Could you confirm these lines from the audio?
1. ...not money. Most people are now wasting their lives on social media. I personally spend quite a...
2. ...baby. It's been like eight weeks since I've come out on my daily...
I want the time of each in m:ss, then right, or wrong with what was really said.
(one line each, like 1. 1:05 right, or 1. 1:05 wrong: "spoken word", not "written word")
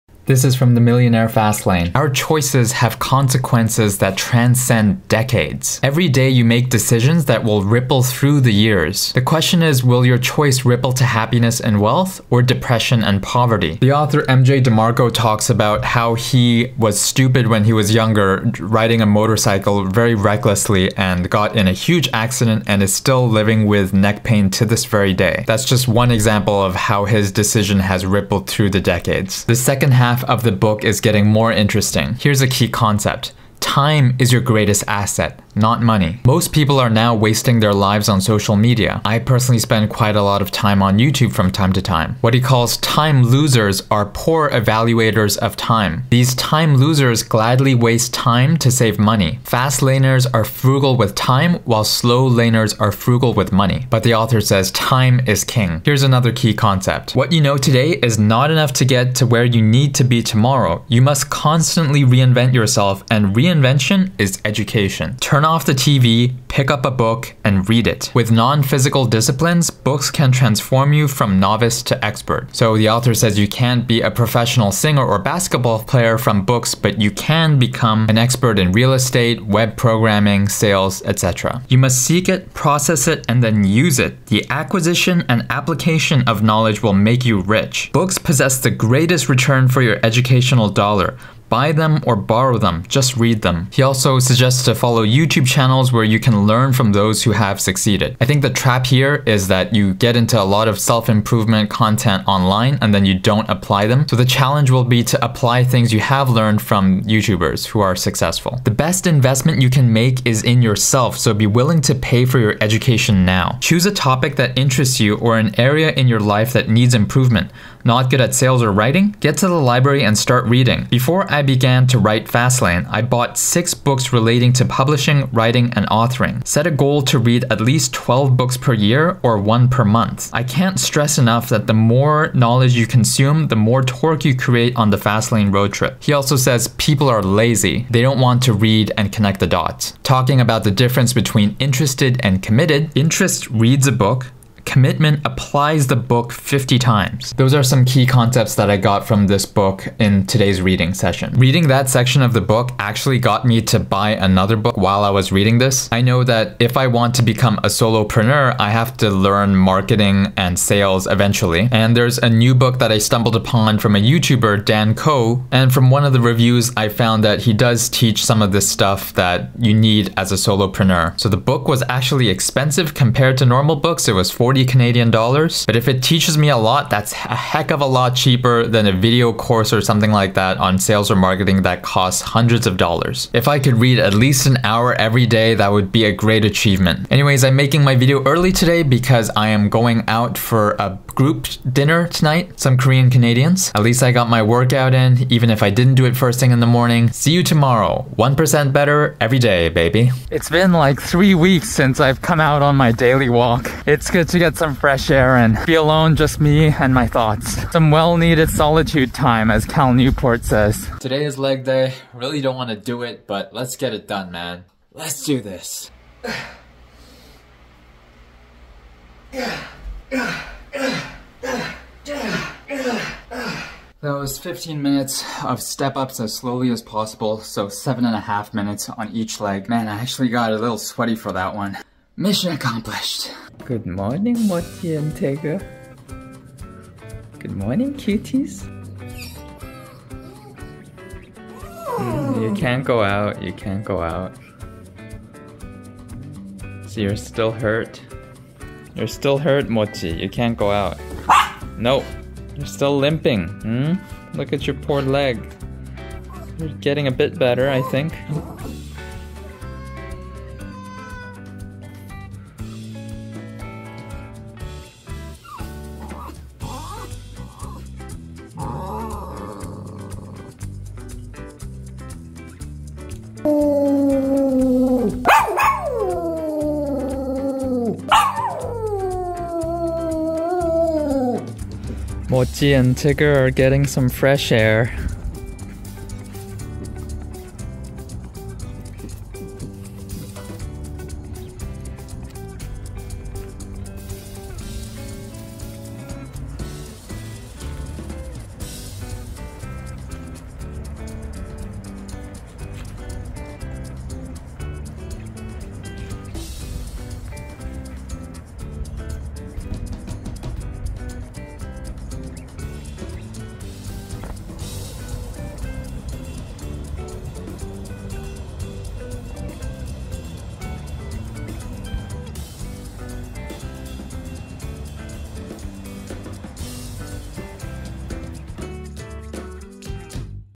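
1. 0:35 right
2. 3:19 wrong: "three", not "eight".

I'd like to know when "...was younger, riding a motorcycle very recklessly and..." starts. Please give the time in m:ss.
0:17.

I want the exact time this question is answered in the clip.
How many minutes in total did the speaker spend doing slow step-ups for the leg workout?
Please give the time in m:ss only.
3:44.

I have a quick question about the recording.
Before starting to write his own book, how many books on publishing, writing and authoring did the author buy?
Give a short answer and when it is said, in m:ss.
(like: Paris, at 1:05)
6, at 2:03.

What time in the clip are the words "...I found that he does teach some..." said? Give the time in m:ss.
2:46.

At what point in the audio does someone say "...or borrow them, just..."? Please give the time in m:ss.
1:32.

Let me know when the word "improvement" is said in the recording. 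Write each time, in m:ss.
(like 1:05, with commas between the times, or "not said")
1:40, 1:56.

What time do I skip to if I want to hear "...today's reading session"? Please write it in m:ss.
2:30.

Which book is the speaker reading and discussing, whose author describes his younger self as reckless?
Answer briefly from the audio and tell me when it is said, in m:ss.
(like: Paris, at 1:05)
The Millionaire Fastlane, at 0:00.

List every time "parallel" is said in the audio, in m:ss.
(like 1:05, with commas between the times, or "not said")
not said.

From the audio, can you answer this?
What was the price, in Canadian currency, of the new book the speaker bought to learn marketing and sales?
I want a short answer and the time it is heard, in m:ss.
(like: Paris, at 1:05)
40 Canadian dollars, at 2:54.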